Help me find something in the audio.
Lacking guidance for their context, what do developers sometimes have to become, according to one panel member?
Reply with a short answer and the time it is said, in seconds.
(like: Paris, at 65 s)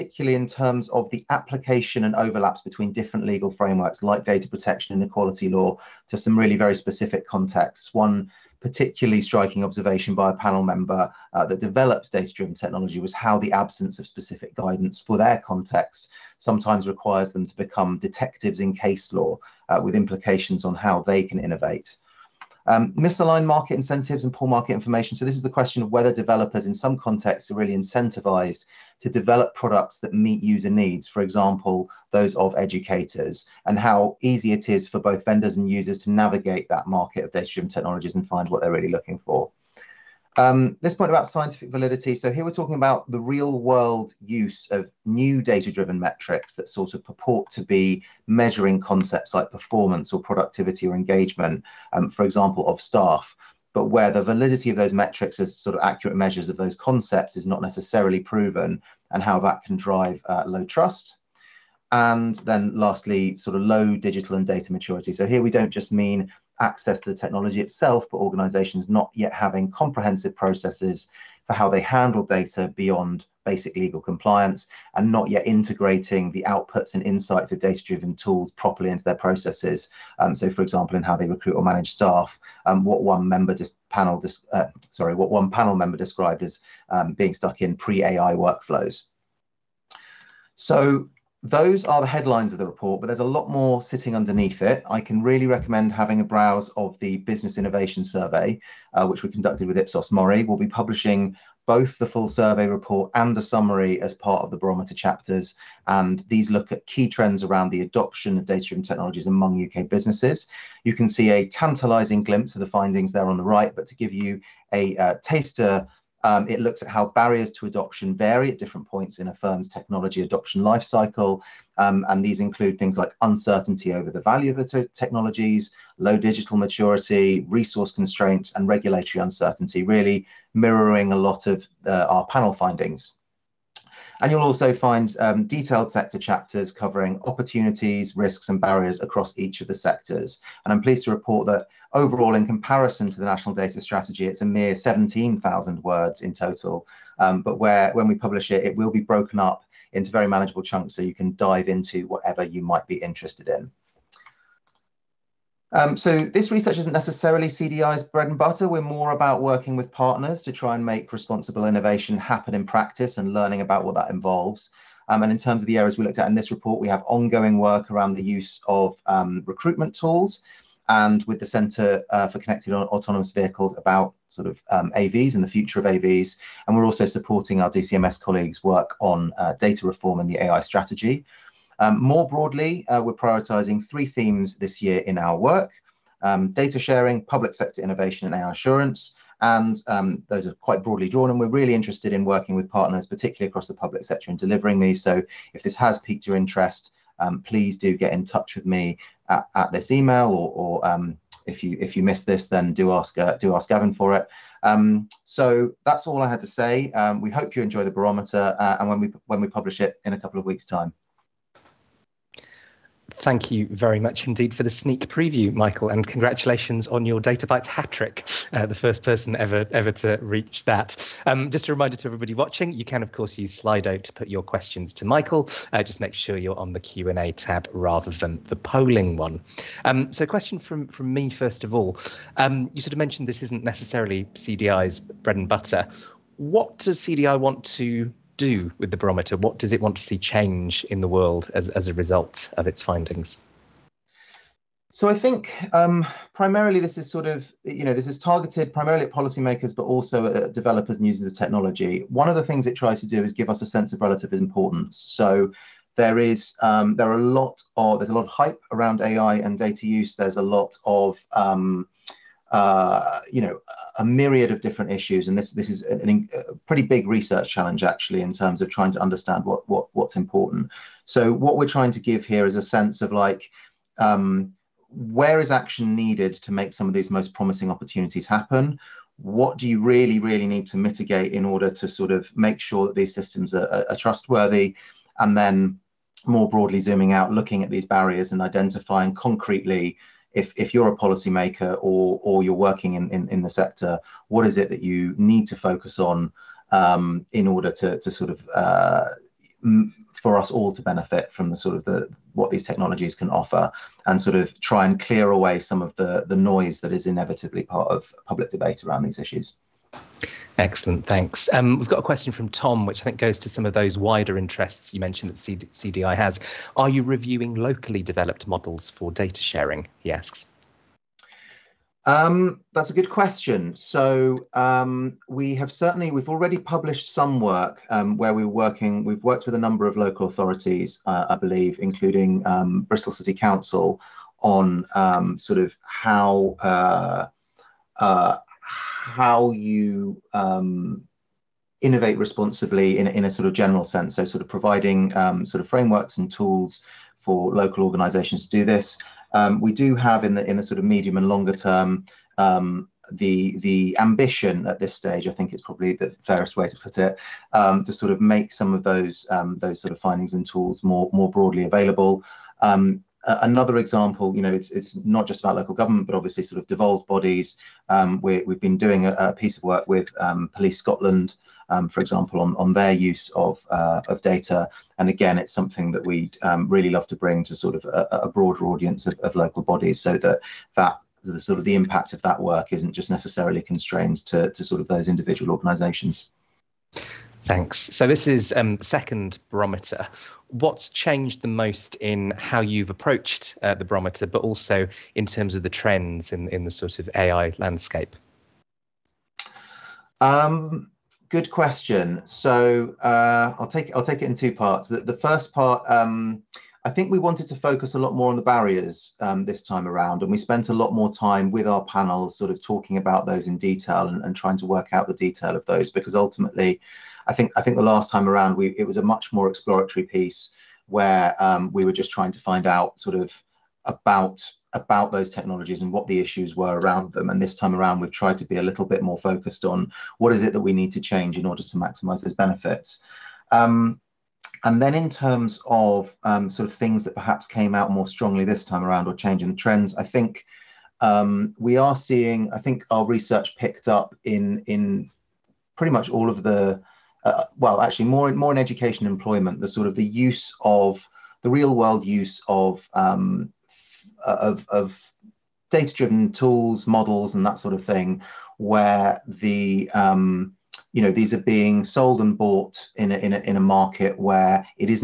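Detectives, at 17 s.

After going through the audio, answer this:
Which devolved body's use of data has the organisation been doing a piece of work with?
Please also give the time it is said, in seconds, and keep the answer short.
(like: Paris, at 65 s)
Police Scotland, at 370 s.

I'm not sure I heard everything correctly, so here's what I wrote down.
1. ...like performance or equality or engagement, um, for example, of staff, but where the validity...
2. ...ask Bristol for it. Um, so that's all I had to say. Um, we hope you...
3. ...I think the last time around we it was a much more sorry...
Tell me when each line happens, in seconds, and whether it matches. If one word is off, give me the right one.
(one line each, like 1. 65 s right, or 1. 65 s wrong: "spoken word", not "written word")
1. 49 s wrong: "productivity", not "equality"
2. 203 s wrong: "Gavin", not "Bristol"
3. 417 s wrong: "exploratory", not "sorry".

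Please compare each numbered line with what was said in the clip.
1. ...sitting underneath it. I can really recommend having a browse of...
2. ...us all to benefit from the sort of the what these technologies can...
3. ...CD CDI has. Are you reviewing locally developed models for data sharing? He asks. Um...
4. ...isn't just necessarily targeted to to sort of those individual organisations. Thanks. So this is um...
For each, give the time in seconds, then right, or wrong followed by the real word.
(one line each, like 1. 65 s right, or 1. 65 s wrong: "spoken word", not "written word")
1. 93 s right
2. 300 s right
3. 315 s right
4. 382 s wrong: "constrained", not "targeted".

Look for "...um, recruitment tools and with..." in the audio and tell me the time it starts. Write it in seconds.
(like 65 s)
169 s.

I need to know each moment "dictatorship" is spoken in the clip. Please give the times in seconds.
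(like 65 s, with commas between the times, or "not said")
not said.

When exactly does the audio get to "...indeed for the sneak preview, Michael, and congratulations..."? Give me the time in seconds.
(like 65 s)
214 s.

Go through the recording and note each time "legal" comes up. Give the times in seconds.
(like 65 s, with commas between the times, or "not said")
3 s, 73 s.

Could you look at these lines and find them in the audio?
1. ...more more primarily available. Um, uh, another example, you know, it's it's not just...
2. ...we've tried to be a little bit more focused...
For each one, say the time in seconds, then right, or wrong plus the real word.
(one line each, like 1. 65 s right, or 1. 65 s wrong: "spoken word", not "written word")
1. 360 s wrong: "broadly", not "primarily"
2. 427 s right.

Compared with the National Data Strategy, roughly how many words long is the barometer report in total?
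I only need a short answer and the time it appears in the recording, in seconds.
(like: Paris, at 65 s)
17,000, at 144 s.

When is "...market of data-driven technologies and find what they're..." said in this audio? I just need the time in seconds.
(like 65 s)
36 s.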